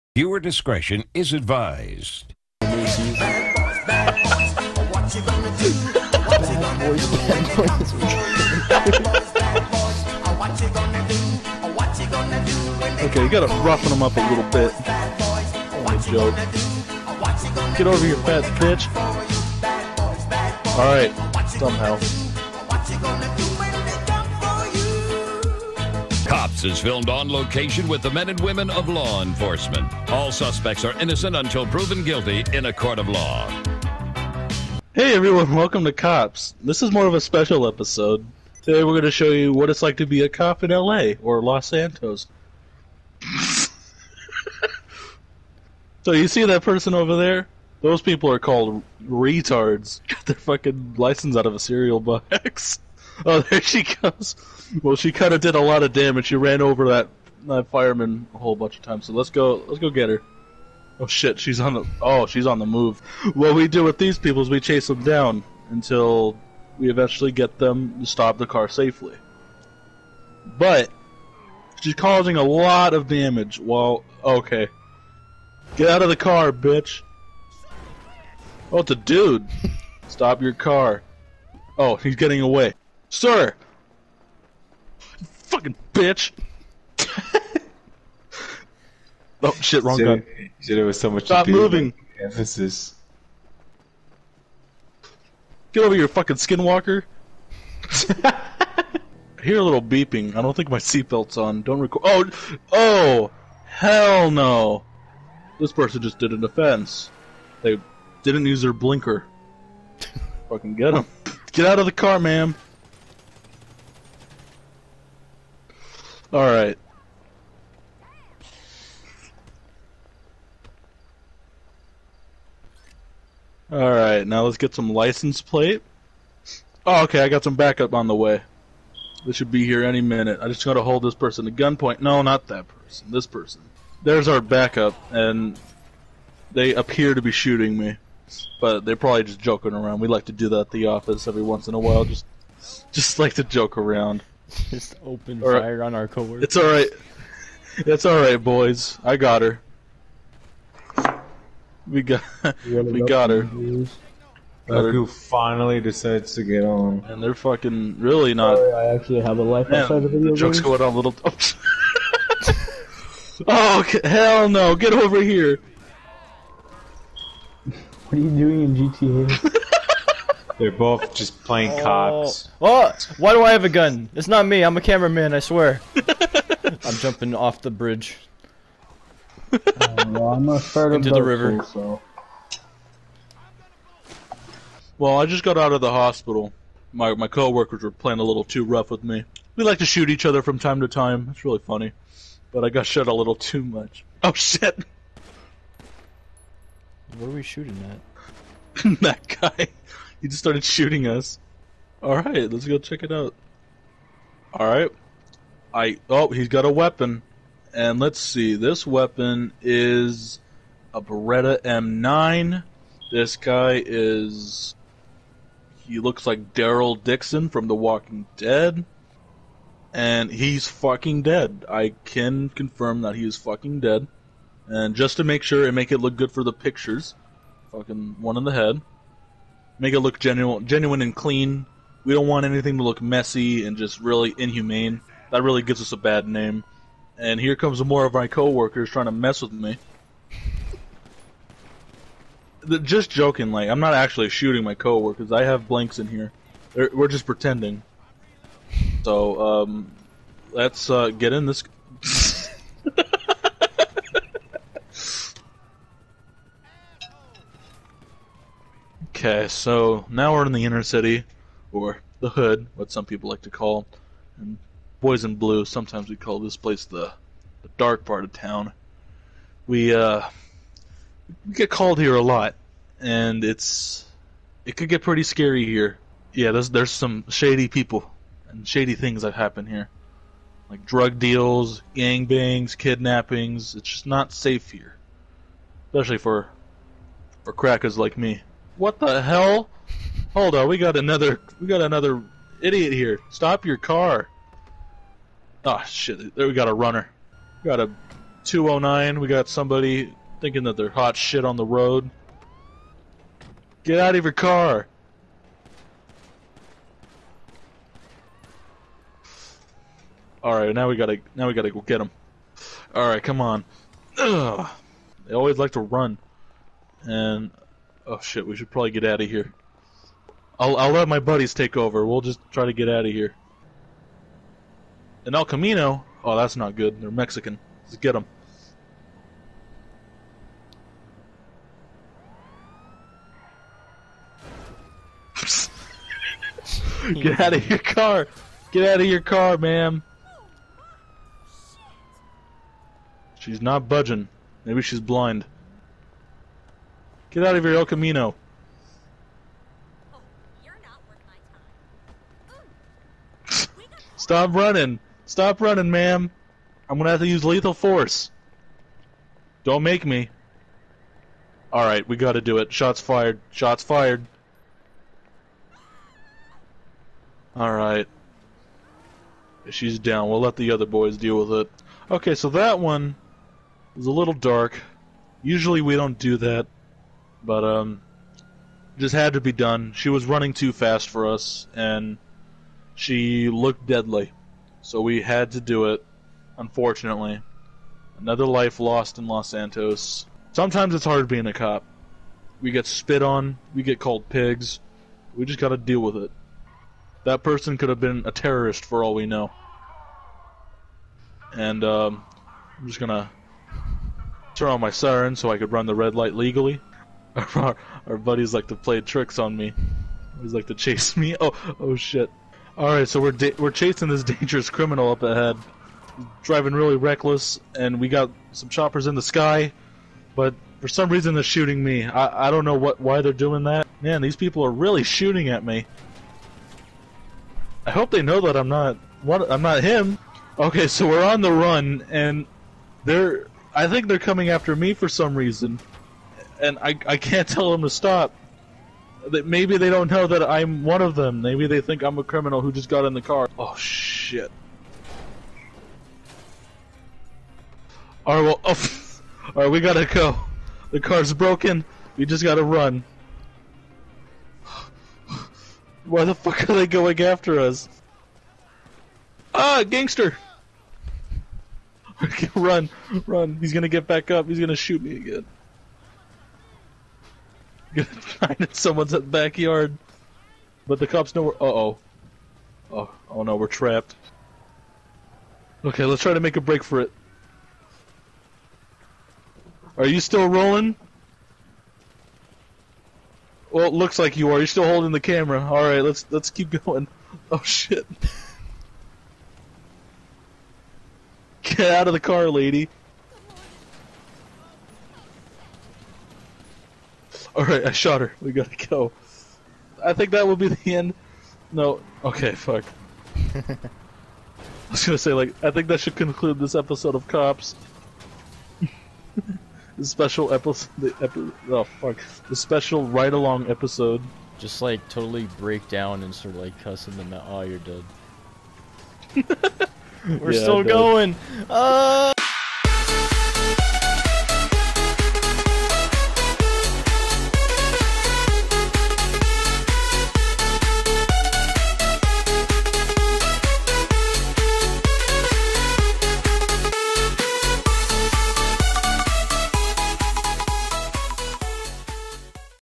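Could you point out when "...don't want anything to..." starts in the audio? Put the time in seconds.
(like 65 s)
232 s.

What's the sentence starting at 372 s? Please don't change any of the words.
Okay, so that one was a little dark.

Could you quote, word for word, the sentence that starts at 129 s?
This should be here any minute.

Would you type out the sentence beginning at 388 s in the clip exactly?
Another life lost in Los Santos.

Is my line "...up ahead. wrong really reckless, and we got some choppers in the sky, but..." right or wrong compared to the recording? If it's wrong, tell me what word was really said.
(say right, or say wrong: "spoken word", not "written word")
wrong: "driving", not "wrong".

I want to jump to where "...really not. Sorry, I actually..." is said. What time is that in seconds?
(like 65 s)
157 s.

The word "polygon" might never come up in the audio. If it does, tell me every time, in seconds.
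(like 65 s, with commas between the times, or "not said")
not said.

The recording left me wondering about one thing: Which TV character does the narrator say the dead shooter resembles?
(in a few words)
Daryl Dixon.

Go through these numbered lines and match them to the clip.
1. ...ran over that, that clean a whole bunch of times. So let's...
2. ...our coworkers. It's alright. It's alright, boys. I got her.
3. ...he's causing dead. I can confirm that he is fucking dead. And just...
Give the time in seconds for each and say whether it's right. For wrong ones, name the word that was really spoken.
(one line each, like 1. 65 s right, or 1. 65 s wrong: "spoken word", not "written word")
1. 56 s wrong: "fireman", not "clean"
2. 145 s right
3. 220 s wrong: "fucking", not "causing".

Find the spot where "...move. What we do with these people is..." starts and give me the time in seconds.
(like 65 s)
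62 s.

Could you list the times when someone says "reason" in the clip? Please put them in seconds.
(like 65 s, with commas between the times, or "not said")
421 s, 435 s.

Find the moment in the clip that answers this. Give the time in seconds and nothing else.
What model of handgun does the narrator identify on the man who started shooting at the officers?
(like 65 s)
211 s.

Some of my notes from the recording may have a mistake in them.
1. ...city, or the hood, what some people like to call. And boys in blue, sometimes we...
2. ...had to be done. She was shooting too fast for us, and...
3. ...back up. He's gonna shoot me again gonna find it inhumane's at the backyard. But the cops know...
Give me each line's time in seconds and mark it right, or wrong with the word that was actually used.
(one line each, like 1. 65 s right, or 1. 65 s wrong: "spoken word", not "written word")
1. 260 s right
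2. 379 s wrong: "running", not "shooting"
3. 464 s wrong: "someone", not "inhumane".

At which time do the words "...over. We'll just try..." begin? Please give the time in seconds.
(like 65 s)
321 s.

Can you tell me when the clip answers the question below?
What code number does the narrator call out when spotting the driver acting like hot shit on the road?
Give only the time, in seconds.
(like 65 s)
298 s.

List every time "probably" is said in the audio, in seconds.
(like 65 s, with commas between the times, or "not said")
138 s, 318 s.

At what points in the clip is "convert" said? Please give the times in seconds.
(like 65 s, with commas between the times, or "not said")
not said.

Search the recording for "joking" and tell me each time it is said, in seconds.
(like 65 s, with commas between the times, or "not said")
139 s, 243 s.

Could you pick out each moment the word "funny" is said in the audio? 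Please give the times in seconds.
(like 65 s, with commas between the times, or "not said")
191 s.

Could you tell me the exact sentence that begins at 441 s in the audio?
Maybe they think I'm a criminal who just got in the car.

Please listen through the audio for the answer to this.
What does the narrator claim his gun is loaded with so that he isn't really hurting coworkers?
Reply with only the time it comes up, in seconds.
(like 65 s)
245 s.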